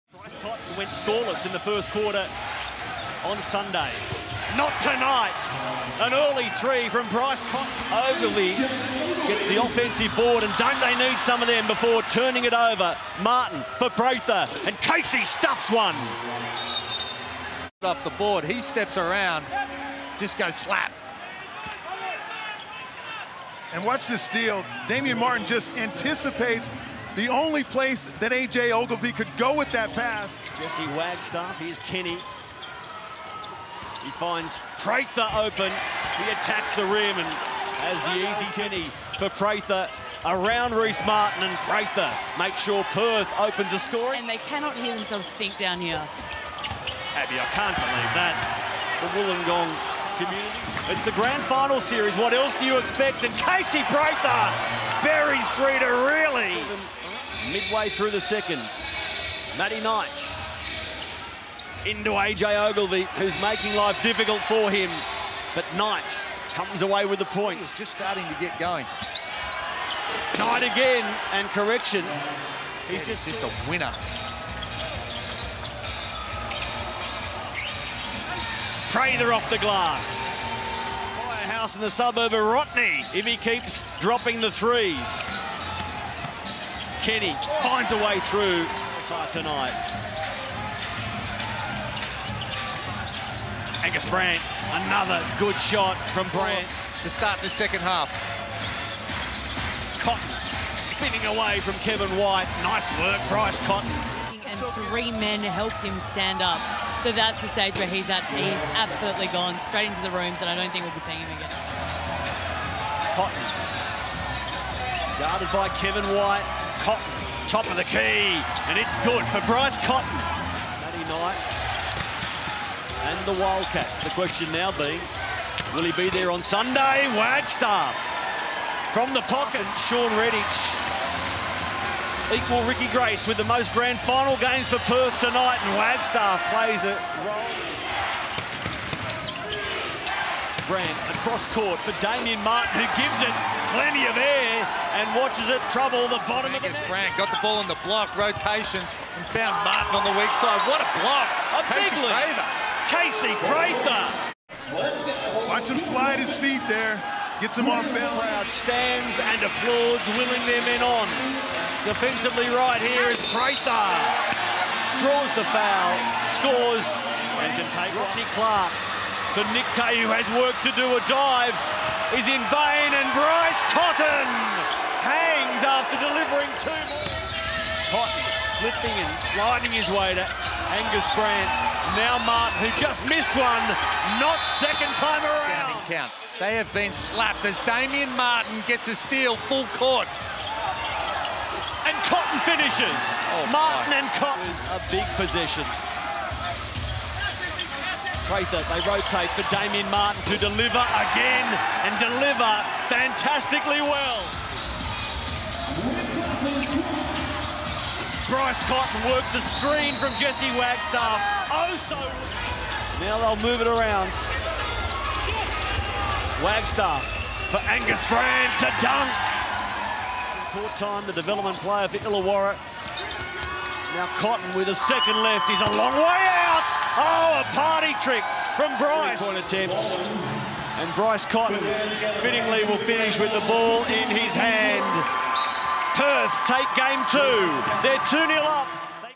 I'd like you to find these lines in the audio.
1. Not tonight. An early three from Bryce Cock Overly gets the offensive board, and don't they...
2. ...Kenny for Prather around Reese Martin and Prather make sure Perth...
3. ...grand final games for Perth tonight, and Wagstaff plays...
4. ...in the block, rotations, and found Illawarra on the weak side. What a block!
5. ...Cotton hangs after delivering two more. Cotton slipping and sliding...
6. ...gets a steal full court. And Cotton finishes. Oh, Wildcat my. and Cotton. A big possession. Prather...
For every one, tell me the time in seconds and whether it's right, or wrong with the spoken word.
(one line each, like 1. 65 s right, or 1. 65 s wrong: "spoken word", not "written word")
1. 4 s right
2. 38 s right
3. 133 s right
4. 147 s wrong: "Martin", not "Illawarra"
5. 173 s right
6. 188 s wrong: "Martin", not "Wildcat".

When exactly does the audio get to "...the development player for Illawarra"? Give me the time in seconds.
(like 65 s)
221 s.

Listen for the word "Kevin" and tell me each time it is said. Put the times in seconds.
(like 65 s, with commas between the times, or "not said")
101 s, 115 s.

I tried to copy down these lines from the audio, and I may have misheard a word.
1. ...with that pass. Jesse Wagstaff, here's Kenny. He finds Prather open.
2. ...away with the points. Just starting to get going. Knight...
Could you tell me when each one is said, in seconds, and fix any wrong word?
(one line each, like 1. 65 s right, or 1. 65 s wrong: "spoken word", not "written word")
1. 29 s right
2. 66 s right.